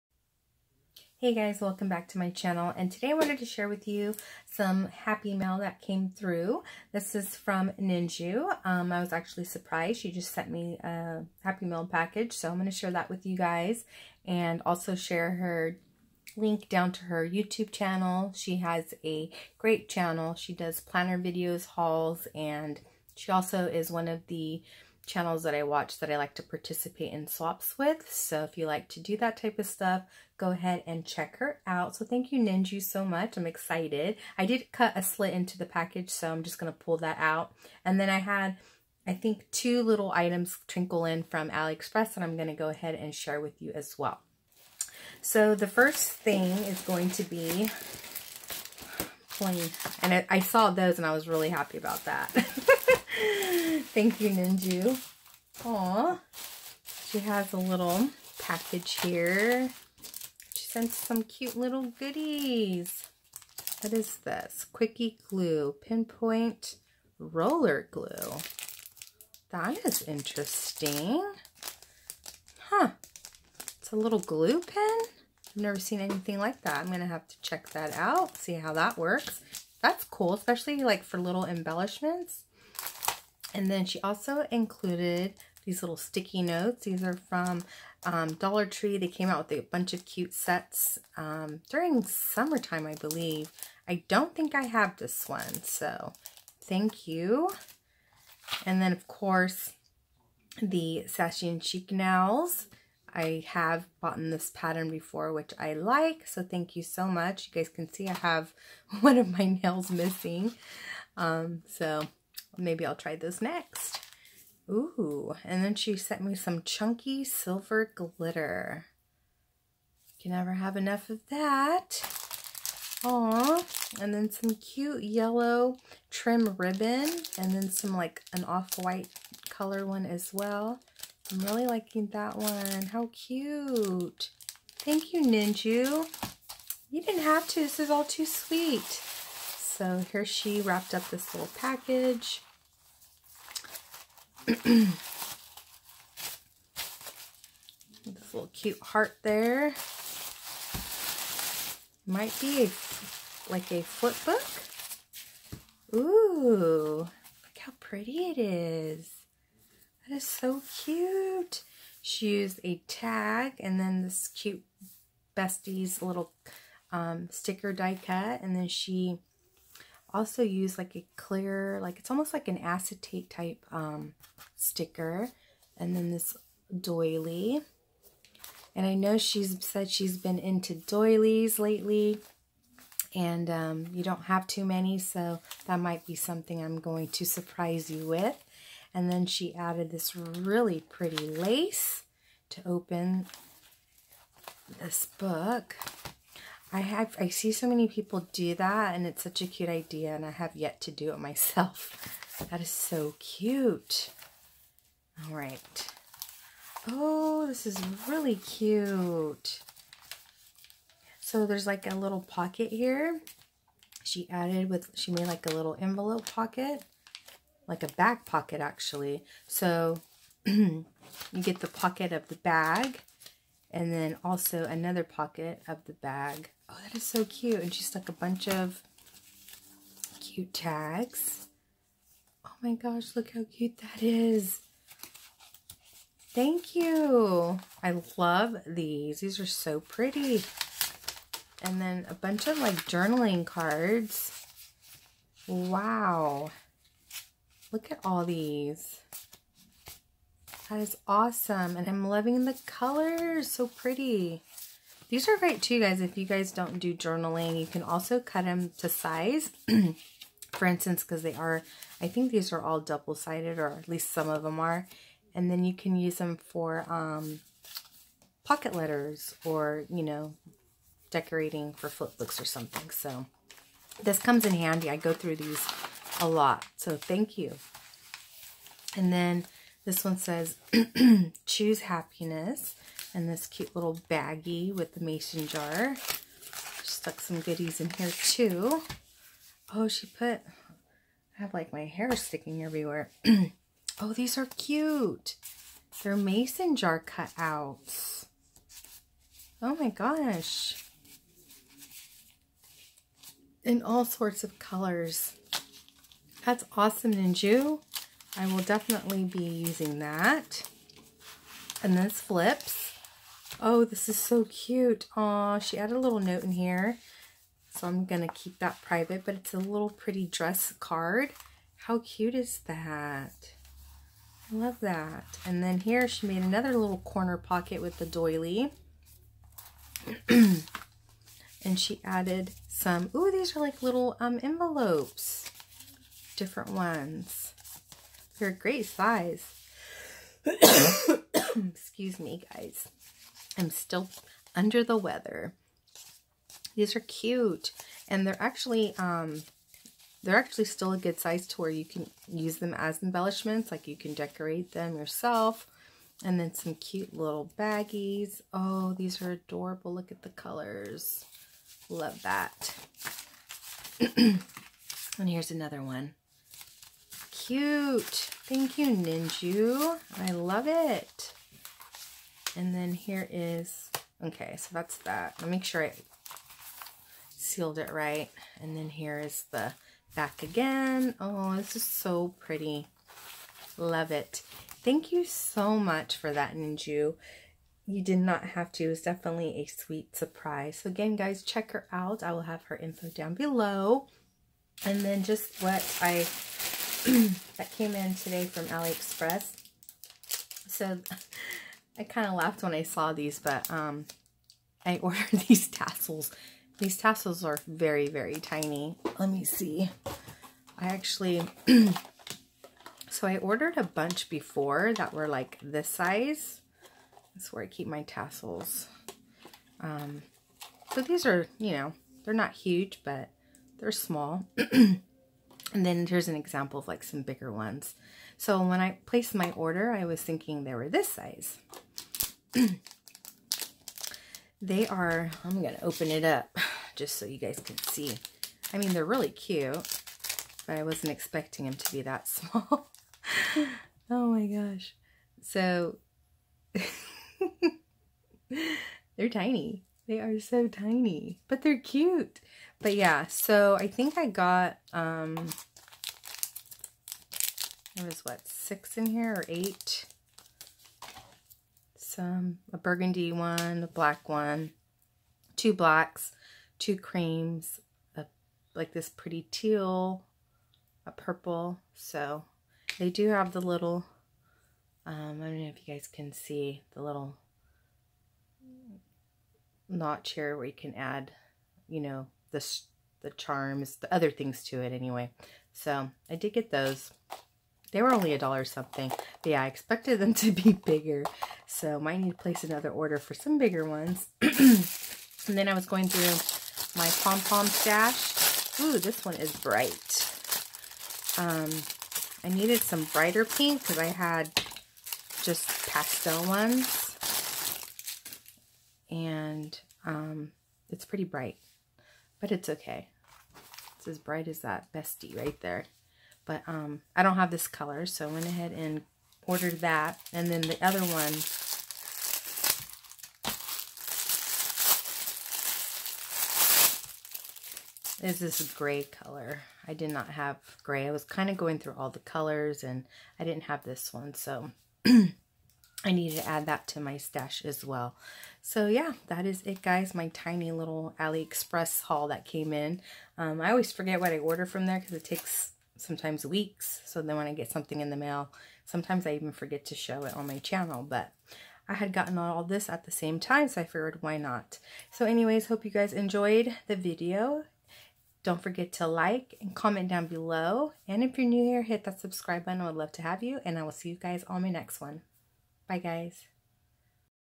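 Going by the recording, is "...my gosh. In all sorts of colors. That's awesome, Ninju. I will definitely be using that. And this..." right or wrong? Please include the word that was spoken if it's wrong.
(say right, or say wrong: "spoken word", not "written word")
right.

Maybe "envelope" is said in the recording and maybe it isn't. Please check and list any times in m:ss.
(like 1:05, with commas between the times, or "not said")
3:35, 5:34.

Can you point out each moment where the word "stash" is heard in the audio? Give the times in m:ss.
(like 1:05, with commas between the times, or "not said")
8:17, 8:57.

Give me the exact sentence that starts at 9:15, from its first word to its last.
So anyways, hope you guys enjoyed the video.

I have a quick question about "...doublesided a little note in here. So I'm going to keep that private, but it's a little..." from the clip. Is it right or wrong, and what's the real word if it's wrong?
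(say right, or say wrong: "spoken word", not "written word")
wrong: "added", not "doublesided".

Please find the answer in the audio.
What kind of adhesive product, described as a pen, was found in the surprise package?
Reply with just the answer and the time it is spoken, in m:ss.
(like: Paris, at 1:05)
pinpoint roller glue, at 1:05.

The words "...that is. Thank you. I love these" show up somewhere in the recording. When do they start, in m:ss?
3:53.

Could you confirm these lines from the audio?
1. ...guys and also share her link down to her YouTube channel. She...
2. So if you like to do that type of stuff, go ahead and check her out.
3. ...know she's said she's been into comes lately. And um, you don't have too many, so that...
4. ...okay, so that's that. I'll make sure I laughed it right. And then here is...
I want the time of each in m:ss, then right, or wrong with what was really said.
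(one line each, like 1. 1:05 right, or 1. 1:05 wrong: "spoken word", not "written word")
1. 0:13 right
2. 0:28 right
3. 2:58 wrong: "doilies", not "comes"
4. 6:14 wrong: "sealed", not "laughed".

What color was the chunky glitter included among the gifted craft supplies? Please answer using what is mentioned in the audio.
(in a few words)
silver.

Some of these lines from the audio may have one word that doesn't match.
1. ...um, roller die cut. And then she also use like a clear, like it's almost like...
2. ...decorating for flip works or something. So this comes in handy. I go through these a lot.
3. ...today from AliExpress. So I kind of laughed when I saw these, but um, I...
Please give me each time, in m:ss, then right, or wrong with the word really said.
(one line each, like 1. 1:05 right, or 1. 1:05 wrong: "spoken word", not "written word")
1. 2:46 wrong: "sticker", not "roller"
2. 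4:31 wrong: "books", not "works"
3. 6:38 right.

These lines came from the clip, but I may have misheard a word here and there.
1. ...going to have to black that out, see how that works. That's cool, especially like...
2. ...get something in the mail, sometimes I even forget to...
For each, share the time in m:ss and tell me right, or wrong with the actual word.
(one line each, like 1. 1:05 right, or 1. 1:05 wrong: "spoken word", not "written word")
1. 1:16 wrong: "check", not "black"
2. 9:07 right.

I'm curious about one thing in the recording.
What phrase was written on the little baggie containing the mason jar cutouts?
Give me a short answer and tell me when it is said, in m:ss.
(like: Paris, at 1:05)
choose happiness, at 4:41.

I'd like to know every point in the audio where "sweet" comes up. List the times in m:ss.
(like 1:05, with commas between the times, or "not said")
2:18, 6:29.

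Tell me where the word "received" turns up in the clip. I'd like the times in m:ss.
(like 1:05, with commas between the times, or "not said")
not said.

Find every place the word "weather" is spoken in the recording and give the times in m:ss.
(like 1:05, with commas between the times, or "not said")
5:44.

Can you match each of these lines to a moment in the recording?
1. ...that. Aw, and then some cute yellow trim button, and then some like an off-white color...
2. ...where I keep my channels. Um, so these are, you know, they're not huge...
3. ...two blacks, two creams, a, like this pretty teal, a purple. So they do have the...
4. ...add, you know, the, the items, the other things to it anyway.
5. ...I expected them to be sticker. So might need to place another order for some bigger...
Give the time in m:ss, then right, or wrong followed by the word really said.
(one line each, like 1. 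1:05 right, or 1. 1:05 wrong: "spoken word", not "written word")
1. 2:01 wrong: "ribbon", not "button"
2. 6:57 wrong: "tassels", not "channels"
3. 7:45 right
4. 8:00 wrong: "charms", not "items"
5. 8:09 wrong: "bigger", not "sticker".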